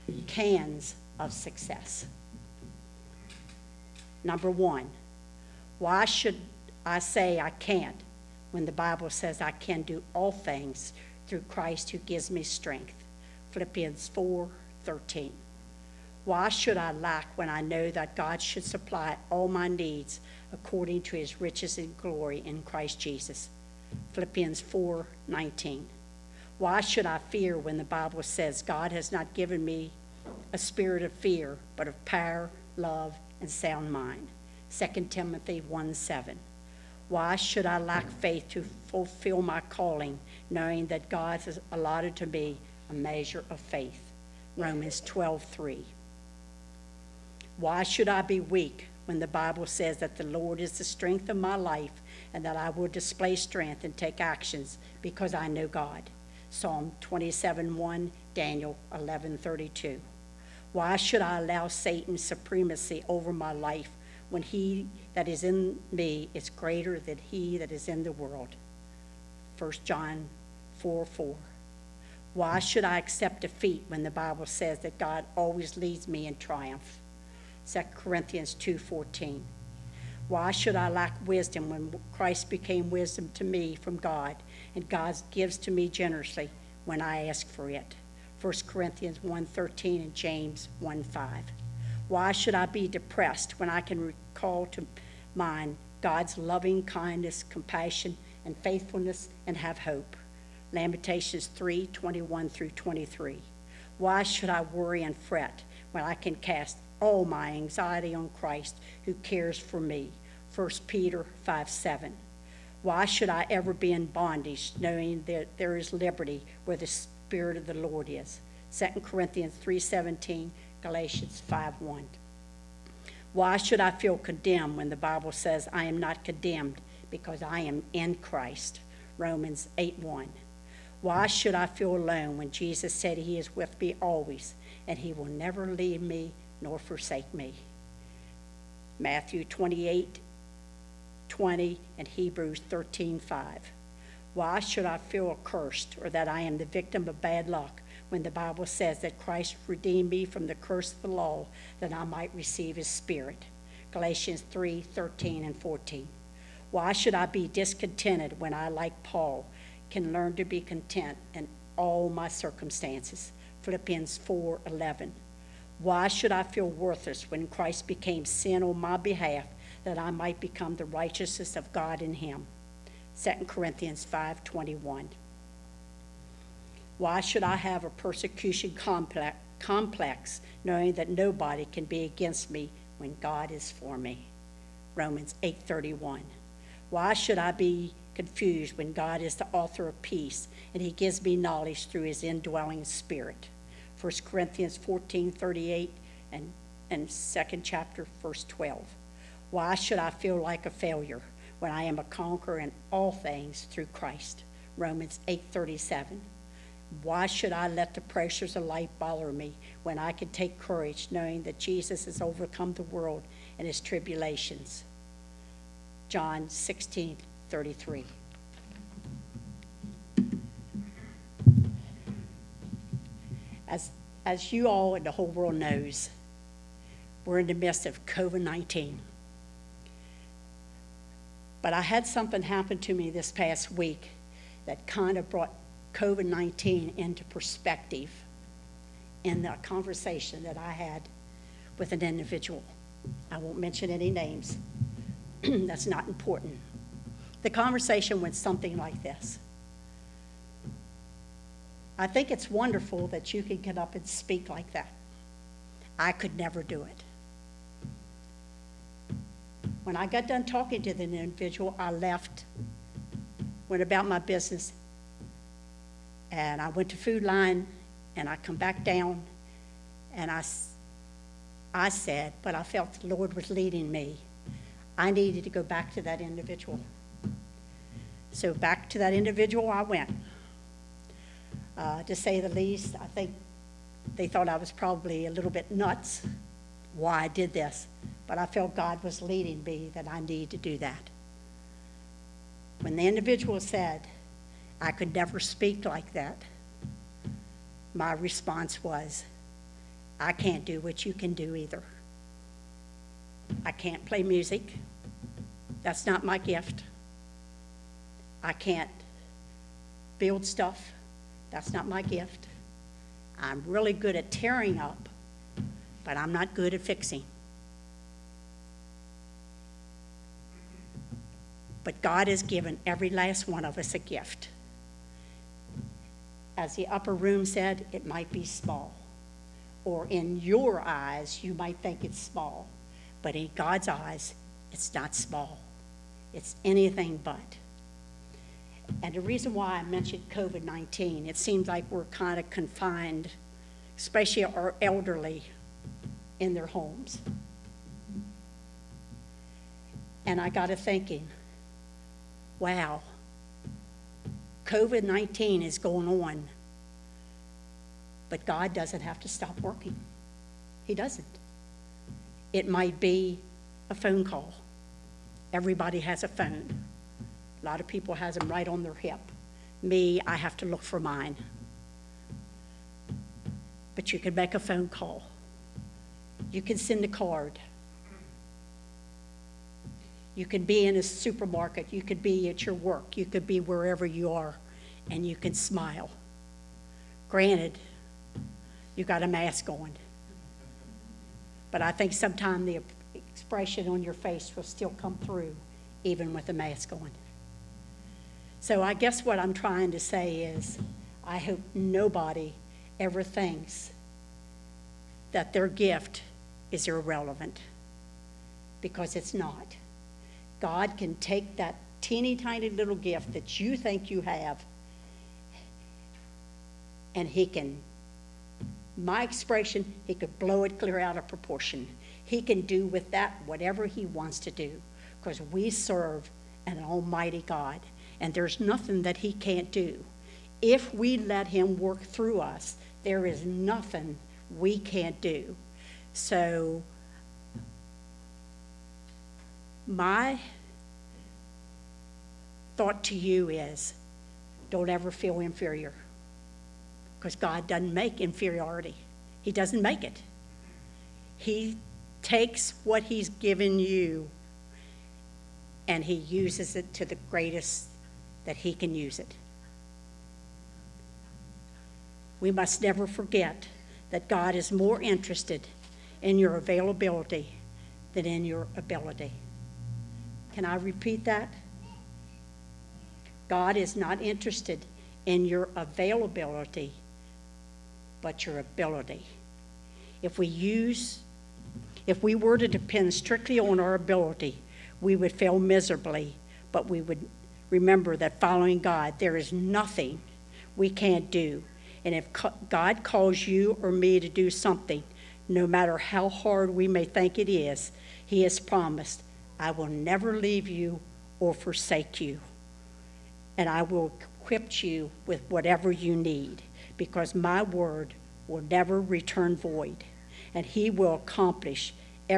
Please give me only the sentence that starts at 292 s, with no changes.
When the individual said, I could never speak like that, my response was, I can't do what you can do either.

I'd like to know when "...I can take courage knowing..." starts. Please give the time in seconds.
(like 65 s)
209 s.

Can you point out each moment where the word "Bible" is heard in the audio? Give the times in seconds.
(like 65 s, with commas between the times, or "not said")
8 s, 27 s, 49 s, 74 s, 124 s, 148 s.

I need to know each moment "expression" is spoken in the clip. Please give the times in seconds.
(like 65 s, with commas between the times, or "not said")
393 s, 419 s.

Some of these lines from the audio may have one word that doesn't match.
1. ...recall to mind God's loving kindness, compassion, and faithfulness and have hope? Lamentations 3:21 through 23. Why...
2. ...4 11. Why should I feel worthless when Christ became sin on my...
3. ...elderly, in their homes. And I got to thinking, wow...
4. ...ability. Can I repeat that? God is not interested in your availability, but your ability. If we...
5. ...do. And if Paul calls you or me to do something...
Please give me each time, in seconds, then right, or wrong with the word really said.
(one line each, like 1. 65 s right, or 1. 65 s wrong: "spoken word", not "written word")
1. 94 s right
2. 164 s right
3. 344 s right
4. 468 s right
5. 491 s wrong: "God", not "Paul".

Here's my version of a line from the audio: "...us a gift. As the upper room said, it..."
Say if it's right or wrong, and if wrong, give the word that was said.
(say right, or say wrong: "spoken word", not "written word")
right.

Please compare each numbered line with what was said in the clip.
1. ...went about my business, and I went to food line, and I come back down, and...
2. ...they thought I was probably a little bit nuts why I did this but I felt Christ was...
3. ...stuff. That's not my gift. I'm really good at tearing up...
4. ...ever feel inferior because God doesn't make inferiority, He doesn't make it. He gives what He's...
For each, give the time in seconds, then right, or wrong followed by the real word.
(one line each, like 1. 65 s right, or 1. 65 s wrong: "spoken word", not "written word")
1. 263 s right
2. 284 s wrong: "God", not "Christ"
3. 310 s right
4. 444 s wrong: "takes", not "gives".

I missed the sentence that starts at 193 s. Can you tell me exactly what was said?
1 Corinthians 14.38 and, and 2nd chapter verse 12.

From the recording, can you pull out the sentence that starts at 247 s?
The conversation went something like this I think it's wonderful that you can get up and speak like that.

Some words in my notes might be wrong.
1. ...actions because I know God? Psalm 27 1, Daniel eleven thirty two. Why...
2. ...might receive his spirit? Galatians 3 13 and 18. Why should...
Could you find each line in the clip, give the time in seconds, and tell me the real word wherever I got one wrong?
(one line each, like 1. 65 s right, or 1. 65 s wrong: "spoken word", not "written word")
1. 54 s right
2. 152 s wrong: "14", not "18".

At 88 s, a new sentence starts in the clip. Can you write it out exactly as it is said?
1 Corinthians 1.13 and James 1.5.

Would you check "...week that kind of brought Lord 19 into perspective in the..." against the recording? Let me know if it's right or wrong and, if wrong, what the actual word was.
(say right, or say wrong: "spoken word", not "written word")
wrong: "COVID", not "Lord".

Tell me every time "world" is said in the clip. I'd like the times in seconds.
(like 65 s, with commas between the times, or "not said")
68 s, 212 s, 225 s.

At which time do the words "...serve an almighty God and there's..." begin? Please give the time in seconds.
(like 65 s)
425 s.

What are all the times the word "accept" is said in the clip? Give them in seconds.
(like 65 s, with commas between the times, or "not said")
72 s.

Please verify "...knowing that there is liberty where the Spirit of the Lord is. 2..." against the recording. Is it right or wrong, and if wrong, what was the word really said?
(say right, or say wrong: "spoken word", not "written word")
right.